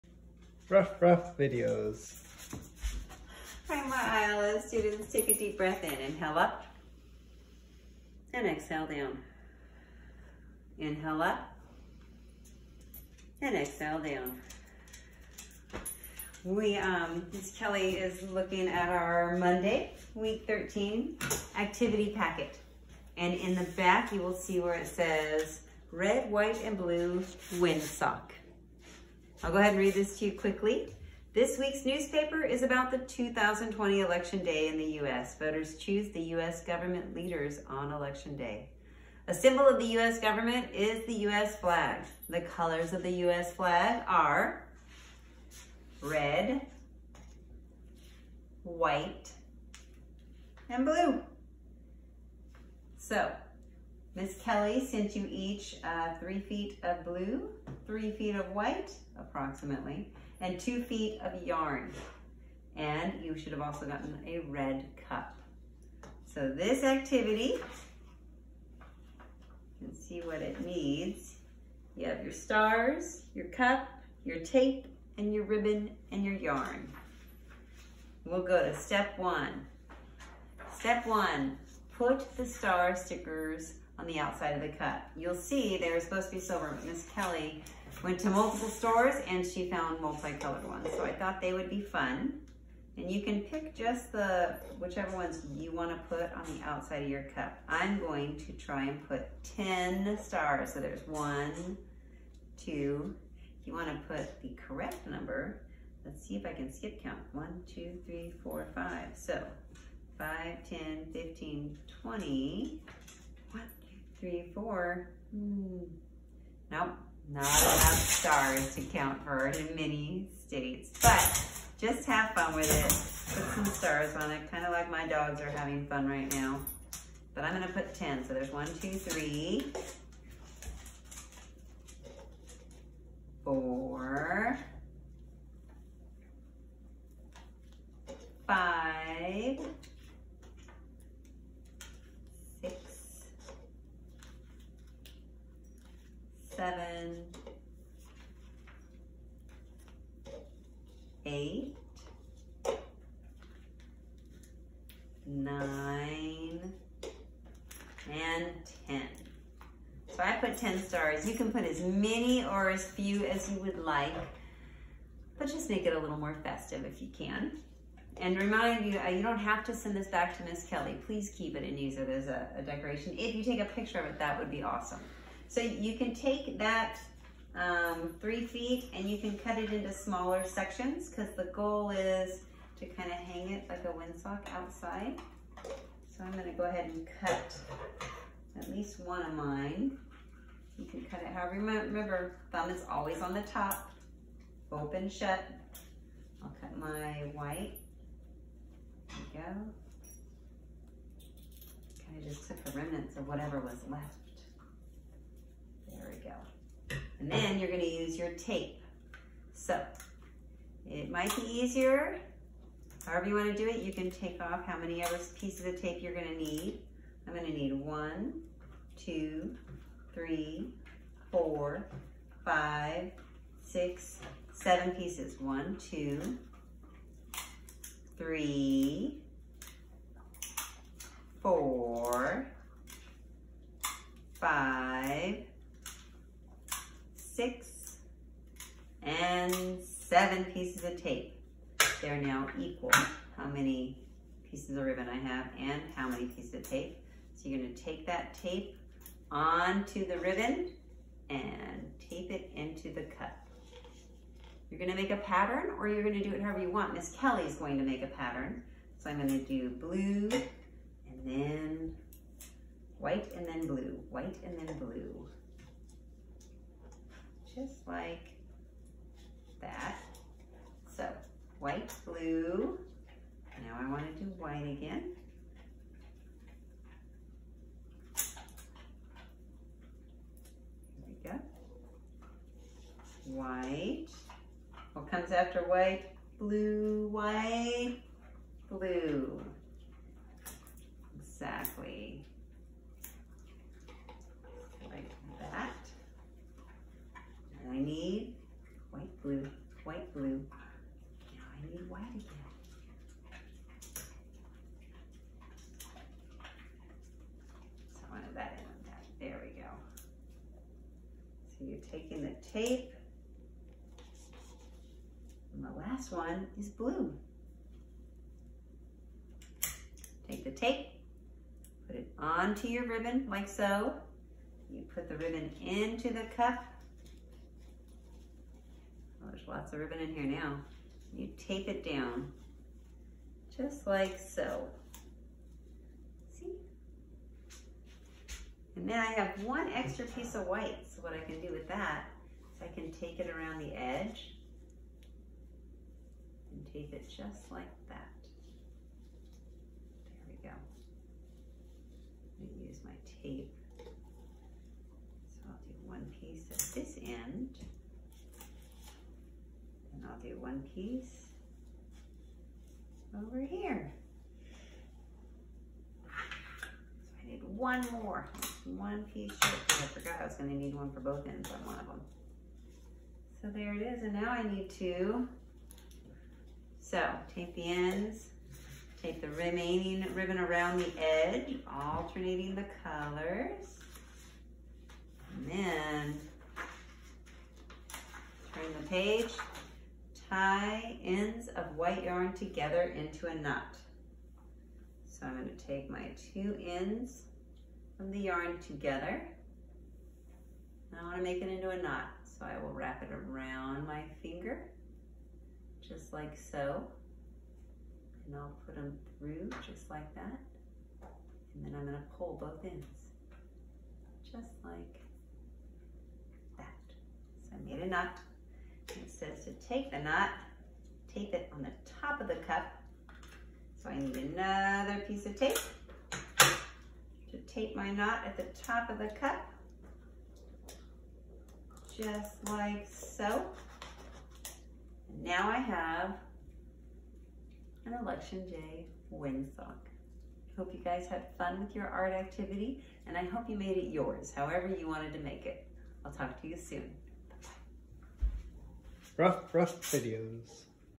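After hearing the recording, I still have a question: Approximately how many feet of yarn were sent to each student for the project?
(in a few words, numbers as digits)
2 feet.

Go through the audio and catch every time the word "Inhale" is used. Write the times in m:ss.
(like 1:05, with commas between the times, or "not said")
0:05, 0:10.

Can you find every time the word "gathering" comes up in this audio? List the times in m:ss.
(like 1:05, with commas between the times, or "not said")
not said.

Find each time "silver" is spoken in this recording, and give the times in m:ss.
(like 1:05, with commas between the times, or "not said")
1:26.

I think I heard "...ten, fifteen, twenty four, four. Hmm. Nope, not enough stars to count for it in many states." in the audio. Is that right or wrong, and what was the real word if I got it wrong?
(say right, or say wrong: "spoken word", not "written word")
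wrong: "three", not "four".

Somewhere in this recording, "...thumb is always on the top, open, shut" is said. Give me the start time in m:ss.
3:12.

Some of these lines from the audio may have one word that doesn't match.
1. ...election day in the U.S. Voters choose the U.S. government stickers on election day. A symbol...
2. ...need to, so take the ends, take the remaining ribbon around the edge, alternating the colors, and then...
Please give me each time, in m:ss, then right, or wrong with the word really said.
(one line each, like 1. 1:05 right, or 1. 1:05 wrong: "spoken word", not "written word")
1. 0:34 wrong: "leaders", not "stickers"
2. 6:14 right.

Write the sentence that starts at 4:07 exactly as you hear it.
So you're gonna take that tape onto the ribbon and tape it into the cut.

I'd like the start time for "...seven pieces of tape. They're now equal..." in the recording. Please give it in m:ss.
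3:59.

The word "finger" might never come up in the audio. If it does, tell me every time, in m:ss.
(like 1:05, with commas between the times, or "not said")
6:44.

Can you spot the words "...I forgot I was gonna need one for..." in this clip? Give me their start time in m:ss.
6:09.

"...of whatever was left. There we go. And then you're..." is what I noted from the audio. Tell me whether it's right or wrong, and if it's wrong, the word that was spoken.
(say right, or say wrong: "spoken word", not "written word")
right.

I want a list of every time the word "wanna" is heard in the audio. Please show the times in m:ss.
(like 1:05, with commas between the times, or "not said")
1:35, 1:43, 3:33.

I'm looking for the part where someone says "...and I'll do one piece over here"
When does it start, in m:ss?
5:59.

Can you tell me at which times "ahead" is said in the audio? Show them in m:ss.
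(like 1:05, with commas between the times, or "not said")
0:29, 3:06.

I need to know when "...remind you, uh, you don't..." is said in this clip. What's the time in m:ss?
2:48.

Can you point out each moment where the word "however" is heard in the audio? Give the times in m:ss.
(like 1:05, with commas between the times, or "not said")
3:11, 3:33, 4:16, 7:24.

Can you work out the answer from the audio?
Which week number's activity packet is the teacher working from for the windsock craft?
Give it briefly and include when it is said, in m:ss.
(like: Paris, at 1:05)
13, at 0:20.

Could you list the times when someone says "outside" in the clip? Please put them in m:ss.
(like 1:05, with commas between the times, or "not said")
1:24, 1:36, 3:04.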